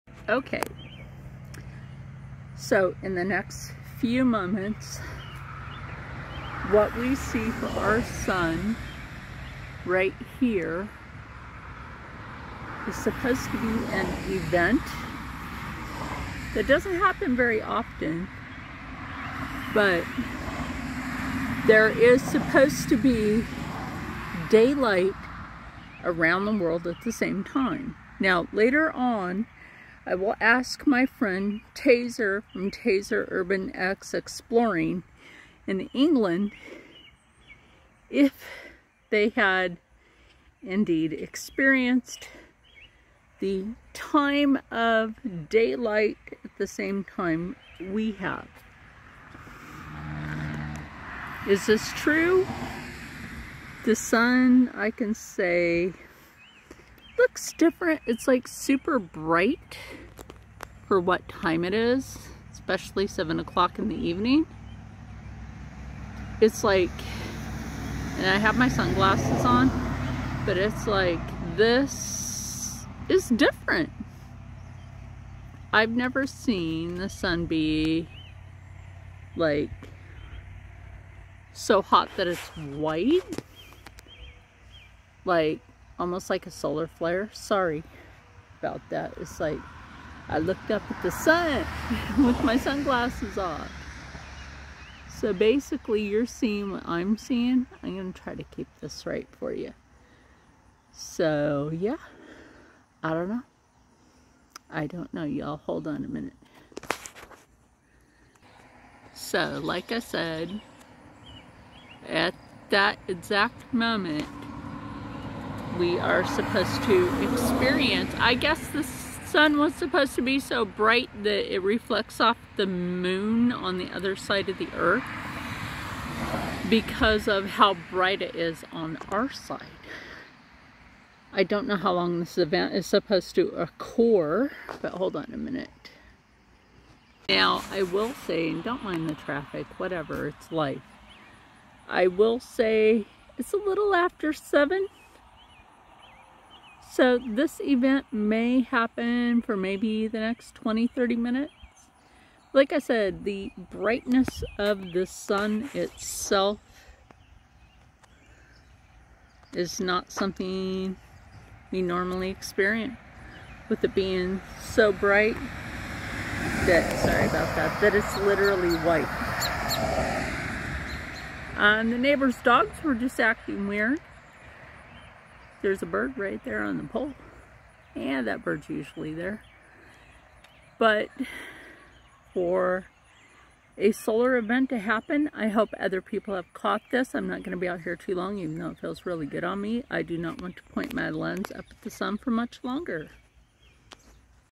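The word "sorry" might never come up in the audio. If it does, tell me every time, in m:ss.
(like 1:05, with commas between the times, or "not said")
1:27, 2:47.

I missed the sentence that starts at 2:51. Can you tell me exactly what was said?
Uh, and the neighbor's dogs were just acting weird.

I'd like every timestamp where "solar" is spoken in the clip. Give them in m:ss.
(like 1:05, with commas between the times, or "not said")
1:26, 3:03.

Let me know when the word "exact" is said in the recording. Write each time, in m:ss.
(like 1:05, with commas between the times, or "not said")
1:53.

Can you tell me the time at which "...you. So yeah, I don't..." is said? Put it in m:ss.
1:39.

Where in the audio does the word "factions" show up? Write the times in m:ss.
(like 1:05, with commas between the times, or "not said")
not said.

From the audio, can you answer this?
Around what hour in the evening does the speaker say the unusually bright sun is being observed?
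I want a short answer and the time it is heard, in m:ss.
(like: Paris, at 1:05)
7, at 1:03.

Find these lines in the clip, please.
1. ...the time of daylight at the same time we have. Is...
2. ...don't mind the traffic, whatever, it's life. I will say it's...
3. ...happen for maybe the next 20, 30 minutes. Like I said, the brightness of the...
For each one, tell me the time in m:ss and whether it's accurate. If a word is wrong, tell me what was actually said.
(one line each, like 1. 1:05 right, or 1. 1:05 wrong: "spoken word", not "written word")
1. 0:43 right
2. 2:18 right
3. 2:28 right.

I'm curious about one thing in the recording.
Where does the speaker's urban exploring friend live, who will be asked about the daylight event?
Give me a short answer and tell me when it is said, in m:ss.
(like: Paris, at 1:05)
England, at 0:35.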